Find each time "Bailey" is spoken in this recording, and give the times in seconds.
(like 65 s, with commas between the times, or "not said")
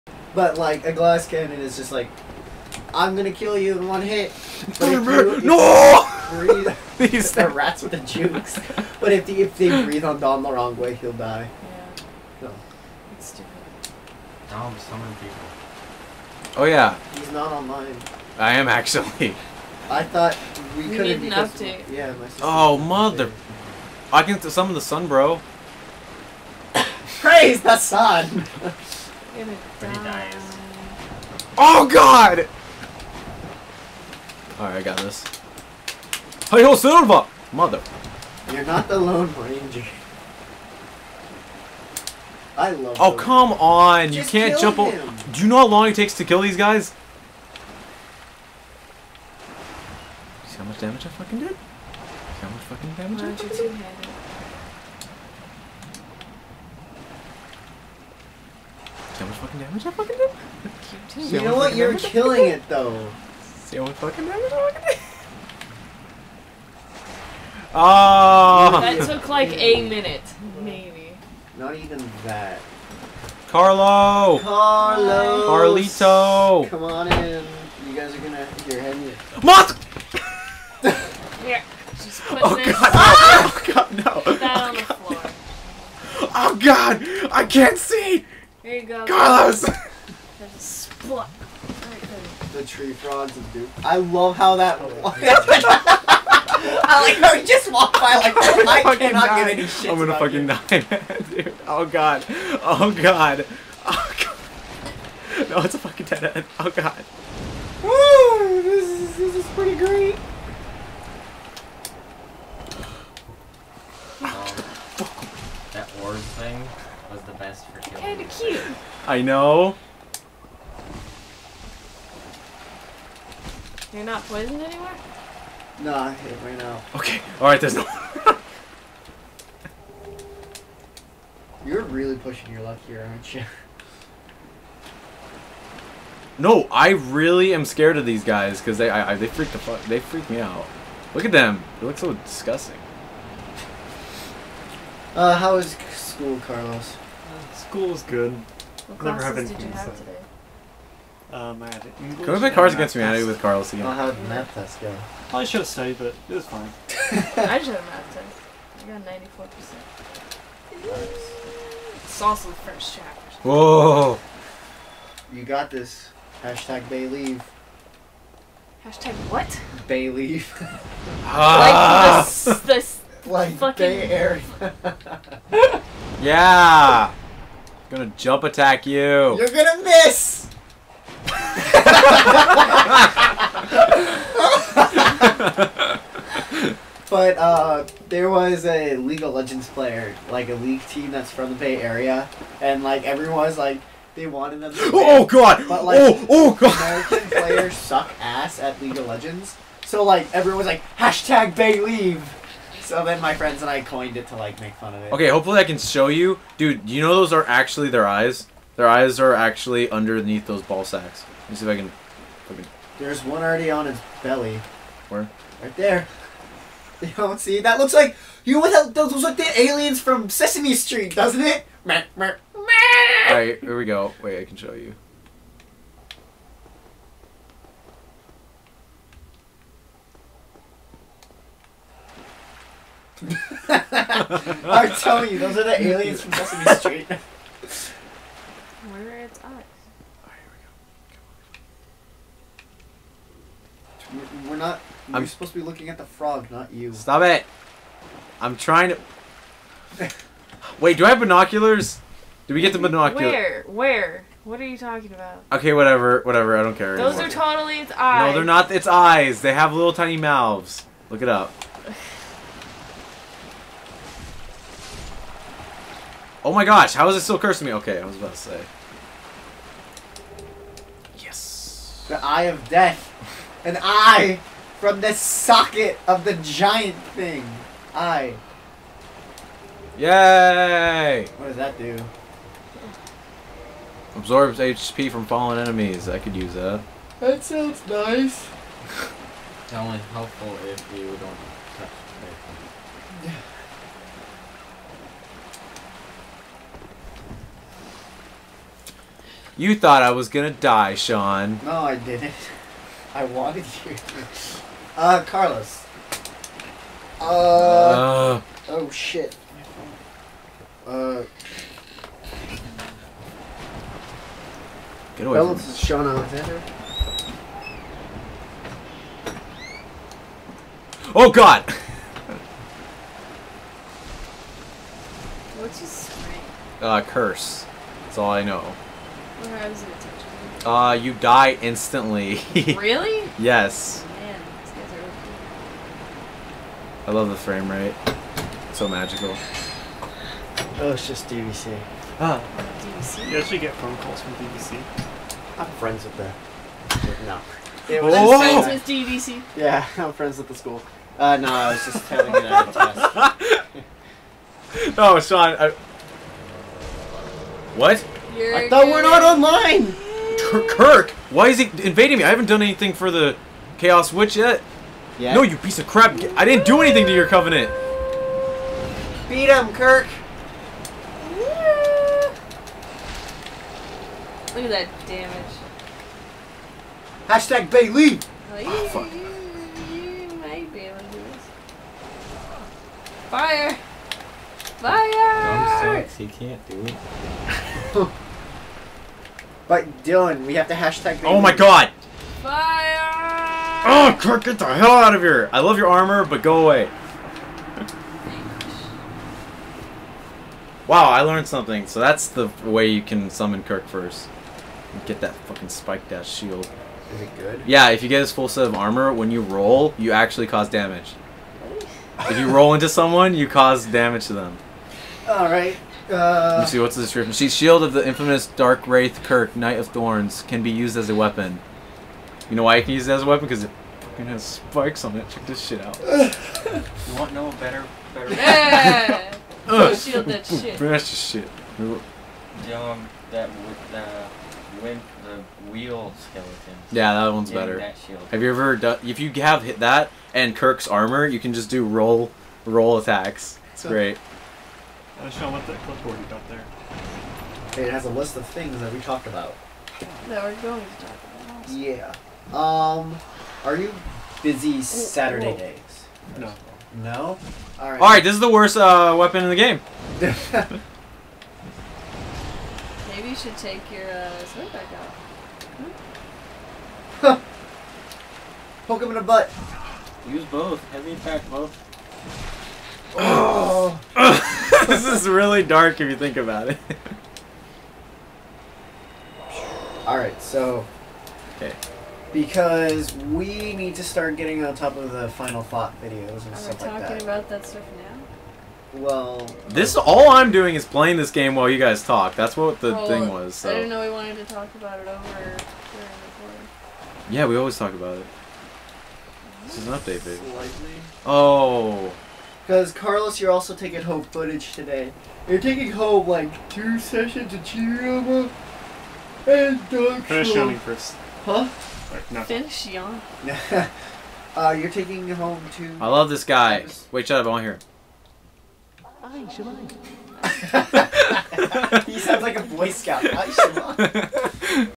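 377 s.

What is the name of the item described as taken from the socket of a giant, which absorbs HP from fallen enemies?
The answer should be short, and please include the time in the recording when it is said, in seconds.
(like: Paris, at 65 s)
The Eye of Death, at 272 s.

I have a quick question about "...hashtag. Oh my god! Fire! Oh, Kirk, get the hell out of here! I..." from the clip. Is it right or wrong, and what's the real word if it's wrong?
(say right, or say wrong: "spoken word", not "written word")
right.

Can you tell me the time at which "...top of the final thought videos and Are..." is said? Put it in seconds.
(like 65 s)
484 s.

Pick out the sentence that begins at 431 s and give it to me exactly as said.
Um, that with the win the wheel skeleton.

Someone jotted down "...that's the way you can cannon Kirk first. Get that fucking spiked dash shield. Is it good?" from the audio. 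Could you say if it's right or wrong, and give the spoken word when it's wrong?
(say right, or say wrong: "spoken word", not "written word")
wrong: "summon", not "cannon".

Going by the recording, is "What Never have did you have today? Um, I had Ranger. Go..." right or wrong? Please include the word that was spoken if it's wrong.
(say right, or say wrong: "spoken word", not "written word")
wrong: "English", not "Ranger".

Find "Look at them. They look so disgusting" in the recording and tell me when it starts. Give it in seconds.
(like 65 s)
141 s.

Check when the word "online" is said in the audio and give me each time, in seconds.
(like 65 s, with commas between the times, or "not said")
17 s, 359 s.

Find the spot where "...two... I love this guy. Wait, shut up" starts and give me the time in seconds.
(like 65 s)
515 s.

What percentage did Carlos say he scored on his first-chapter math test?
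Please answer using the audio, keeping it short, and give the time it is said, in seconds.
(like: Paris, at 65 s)
94%, at 159 s.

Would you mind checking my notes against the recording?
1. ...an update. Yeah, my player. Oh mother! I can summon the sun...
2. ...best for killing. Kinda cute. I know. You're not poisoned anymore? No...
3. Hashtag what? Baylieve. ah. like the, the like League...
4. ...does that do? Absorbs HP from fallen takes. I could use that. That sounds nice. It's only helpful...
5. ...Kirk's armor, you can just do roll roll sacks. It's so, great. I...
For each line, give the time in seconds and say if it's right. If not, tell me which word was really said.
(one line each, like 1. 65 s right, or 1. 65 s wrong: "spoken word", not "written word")
1. 21 s wrong: "sister", not "player"
2. 117 s right
3. 168 s wrong: "Fucking", not "League"
4. 281 s wrong: "enemies", not "takes"
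5. 440 s wrong: "attacks", not "sacks".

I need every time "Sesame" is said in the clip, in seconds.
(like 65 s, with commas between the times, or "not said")
220 s, 236 s.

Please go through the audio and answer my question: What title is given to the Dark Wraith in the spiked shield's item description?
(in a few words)
Knight of Thorns.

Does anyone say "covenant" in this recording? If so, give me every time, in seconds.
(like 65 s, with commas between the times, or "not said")
367 s.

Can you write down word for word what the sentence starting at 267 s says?
Okay, I was about to say.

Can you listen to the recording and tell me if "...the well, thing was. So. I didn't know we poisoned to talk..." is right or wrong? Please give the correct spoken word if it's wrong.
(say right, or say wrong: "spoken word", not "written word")
wrong: "wanted", not "poisoned".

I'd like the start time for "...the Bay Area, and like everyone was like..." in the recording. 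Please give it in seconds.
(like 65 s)
191 s.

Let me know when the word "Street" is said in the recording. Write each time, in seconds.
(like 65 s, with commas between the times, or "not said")
220 s, 236 s.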